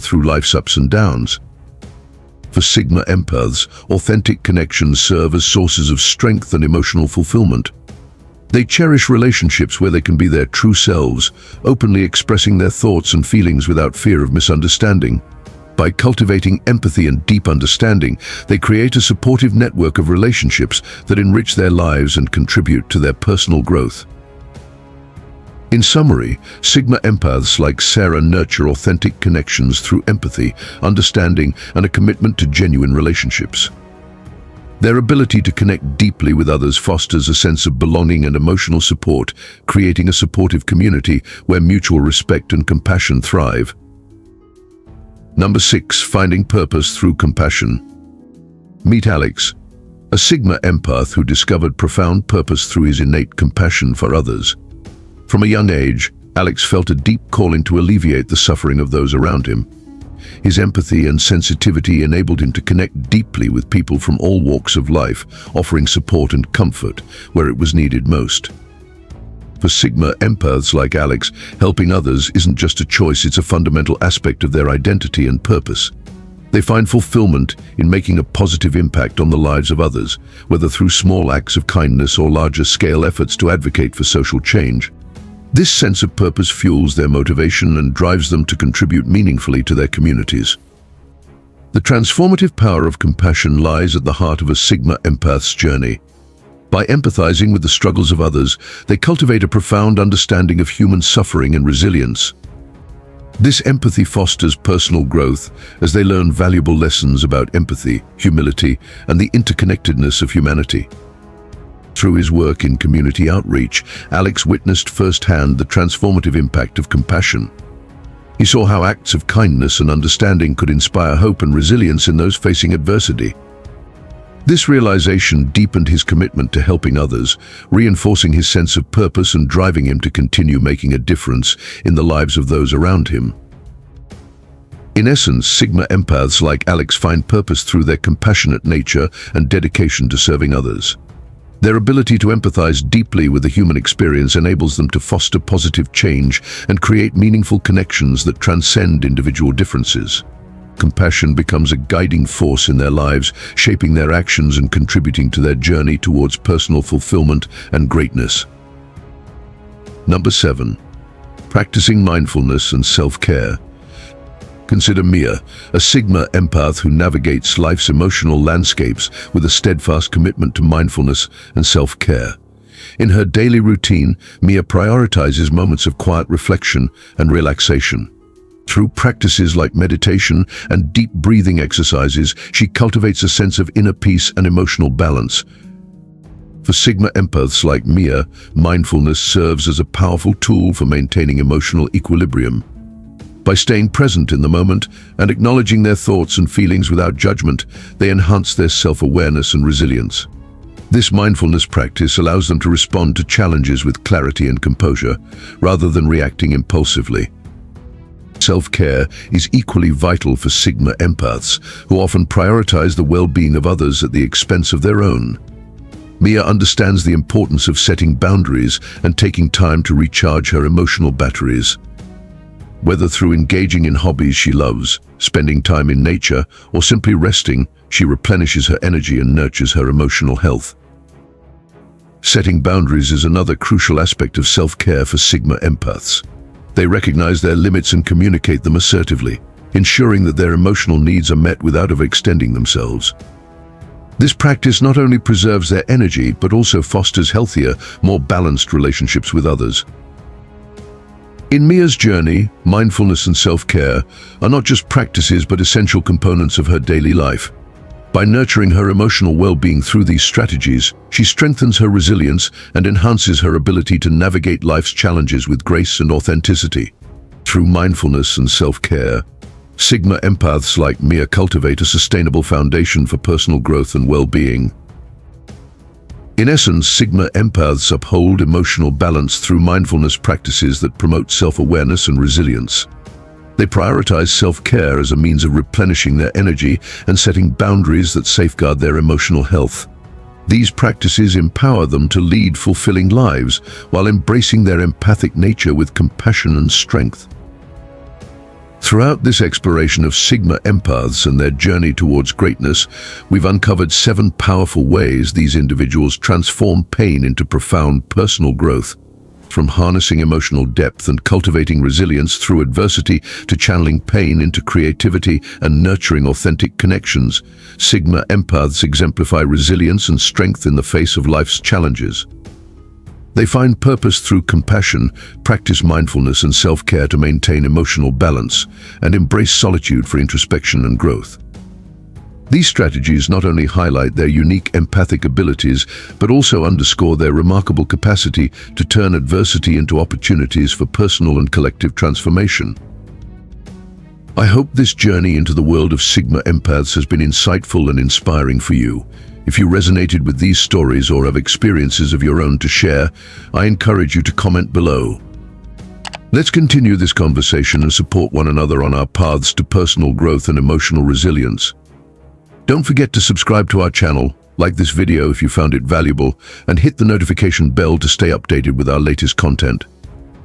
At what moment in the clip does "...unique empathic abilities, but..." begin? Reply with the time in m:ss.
5:34.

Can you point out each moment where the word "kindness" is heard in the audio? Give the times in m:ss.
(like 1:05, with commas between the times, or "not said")
1:21, 1:59.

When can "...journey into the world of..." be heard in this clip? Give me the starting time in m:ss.
5:44.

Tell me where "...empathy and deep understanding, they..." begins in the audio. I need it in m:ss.
0:16.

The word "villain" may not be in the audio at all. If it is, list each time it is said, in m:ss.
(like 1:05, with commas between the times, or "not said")
not said.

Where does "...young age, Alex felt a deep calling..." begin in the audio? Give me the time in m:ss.
0:55.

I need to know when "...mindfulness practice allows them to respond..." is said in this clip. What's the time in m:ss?
3:21.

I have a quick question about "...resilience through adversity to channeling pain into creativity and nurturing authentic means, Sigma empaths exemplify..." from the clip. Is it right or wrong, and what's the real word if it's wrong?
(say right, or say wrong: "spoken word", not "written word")
wrong: "connections", not "means".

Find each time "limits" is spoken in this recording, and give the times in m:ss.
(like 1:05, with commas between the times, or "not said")
3:57.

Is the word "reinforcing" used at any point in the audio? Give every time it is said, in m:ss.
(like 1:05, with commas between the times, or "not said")
2:07.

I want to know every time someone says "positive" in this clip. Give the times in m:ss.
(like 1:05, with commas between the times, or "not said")
1:18, 2:25.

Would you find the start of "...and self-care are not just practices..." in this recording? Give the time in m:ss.
4:13.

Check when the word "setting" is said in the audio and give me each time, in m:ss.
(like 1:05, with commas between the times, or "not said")
3:37, 3:52, 4:47.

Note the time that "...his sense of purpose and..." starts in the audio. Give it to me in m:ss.
2:08.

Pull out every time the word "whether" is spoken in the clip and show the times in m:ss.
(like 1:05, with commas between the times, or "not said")
1:20, 3:42.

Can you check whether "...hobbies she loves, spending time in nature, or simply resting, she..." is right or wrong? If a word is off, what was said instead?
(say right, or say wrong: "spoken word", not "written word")
right.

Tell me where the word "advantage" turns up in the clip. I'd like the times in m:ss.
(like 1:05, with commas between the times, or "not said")
not said.